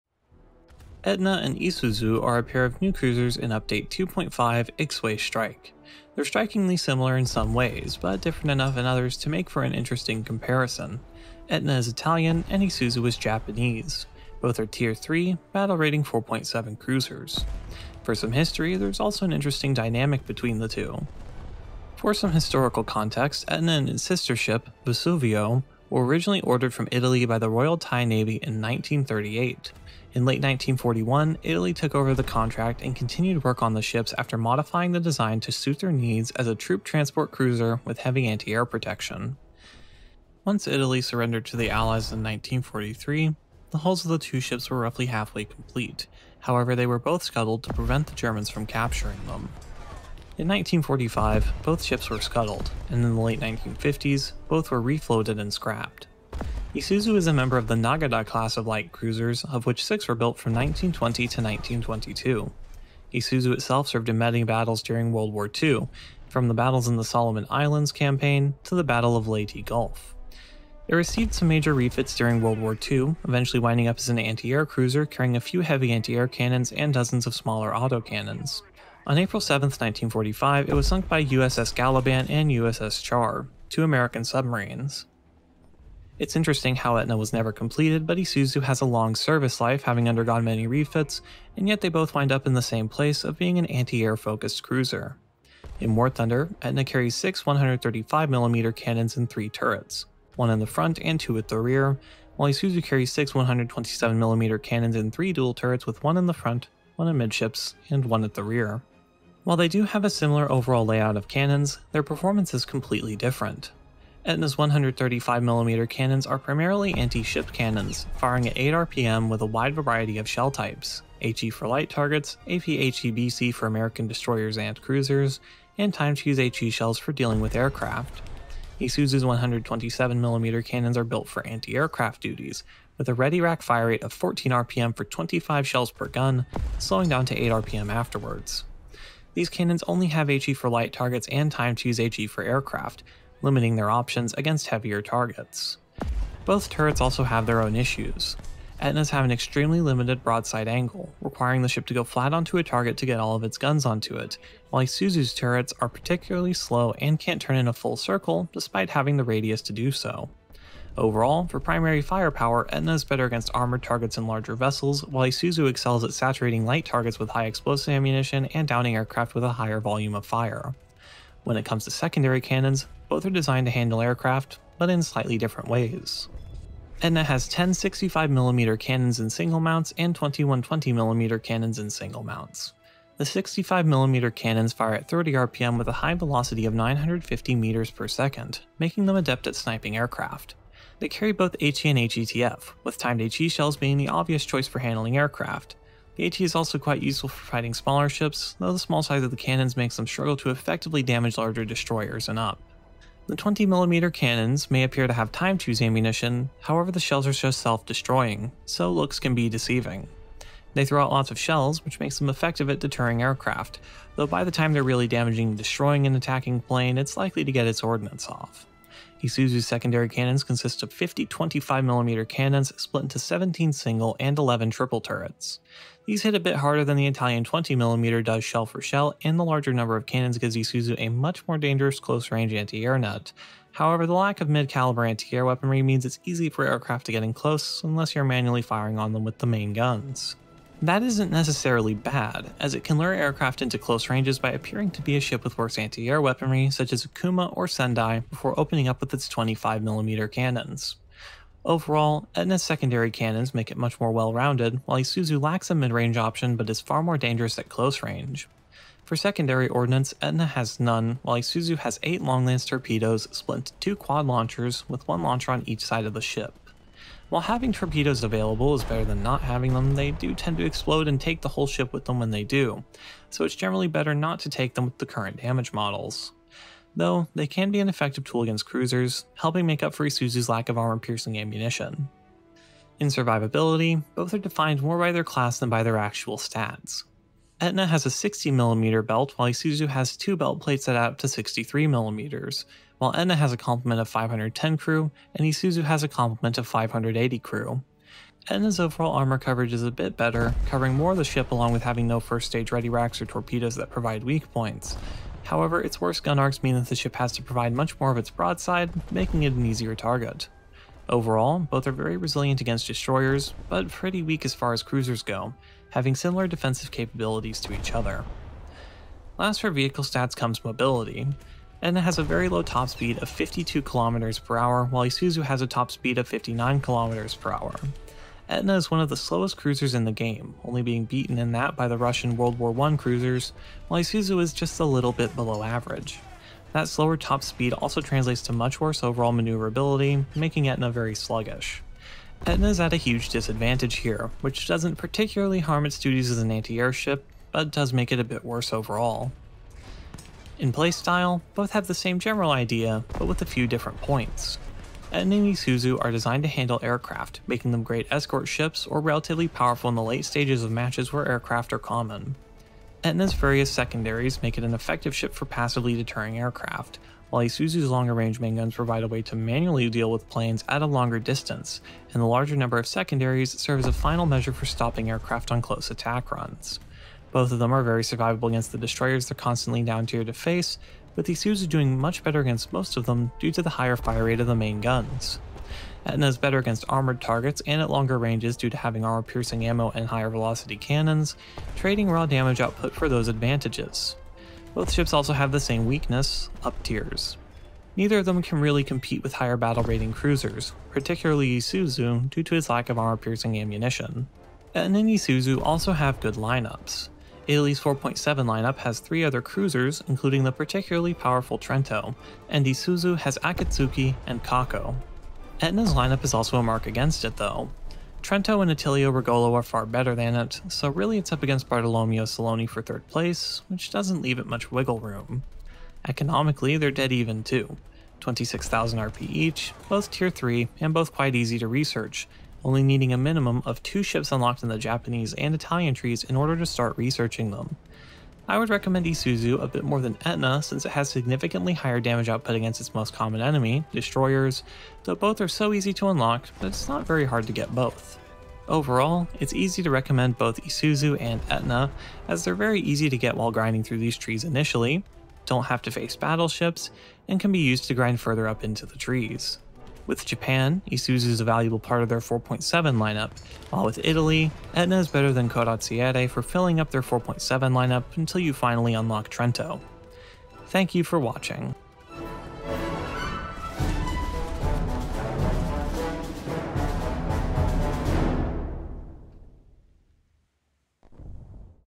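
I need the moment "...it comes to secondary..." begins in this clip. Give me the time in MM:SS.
02:51.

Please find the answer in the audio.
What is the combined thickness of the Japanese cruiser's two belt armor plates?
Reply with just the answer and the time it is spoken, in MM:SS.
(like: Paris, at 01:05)
63 mm, at 04:51.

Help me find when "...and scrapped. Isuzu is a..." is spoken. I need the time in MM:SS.
00:55.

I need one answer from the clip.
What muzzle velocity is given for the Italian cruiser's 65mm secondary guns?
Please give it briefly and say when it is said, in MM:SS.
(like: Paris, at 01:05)
950 meters per second, at 03:06.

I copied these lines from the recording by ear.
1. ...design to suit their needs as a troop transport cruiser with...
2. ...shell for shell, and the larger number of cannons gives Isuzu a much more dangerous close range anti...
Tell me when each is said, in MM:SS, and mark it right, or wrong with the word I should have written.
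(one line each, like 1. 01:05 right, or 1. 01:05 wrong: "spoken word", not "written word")
1. 00:34 right
2. 03:48 right.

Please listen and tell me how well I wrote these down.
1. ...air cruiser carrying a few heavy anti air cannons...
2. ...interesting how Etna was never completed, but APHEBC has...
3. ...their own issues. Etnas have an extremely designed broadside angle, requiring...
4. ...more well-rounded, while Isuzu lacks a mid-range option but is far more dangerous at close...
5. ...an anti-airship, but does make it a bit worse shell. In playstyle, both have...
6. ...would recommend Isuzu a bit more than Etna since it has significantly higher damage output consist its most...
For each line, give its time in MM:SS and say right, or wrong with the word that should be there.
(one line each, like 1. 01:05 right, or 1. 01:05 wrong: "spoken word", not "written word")
1. 01:14 right
2. 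01:26 wrong: "Isuzu", not "APHEBC"
3. 02:27 wrong: "limited", not "designed"
4. 04:13 right
5. 05:46 wrong: "overall", not "shell"
6. 07:18 wrong: "against", not "consist".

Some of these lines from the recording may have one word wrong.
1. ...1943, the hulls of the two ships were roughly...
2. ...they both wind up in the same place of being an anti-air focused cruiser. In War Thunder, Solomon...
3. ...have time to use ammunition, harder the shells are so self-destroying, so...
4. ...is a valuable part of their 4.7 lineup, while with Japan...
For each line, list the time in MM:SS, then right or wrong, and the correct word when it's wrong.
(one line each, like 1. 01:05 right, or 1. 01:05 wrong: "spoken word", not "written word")
1. 00:42 right
2. 01:31 wrong: "Etna", not "Solomon"
3. 03:25 wrong: "however", not "harder"
4. 07:41 wrong: "Italy", not "Japan".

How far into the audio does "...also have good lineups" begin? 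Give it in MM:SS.
06:45.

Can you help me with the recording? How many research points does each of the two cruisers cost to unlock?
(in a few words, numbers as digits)
26,000 RP.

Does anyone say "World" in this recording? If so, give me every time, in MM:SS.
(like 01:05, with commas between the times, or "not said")
01:05, 01:12, 05:32.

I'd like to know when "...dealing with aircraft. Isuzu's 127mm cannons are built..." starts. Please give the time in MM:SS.
02:07.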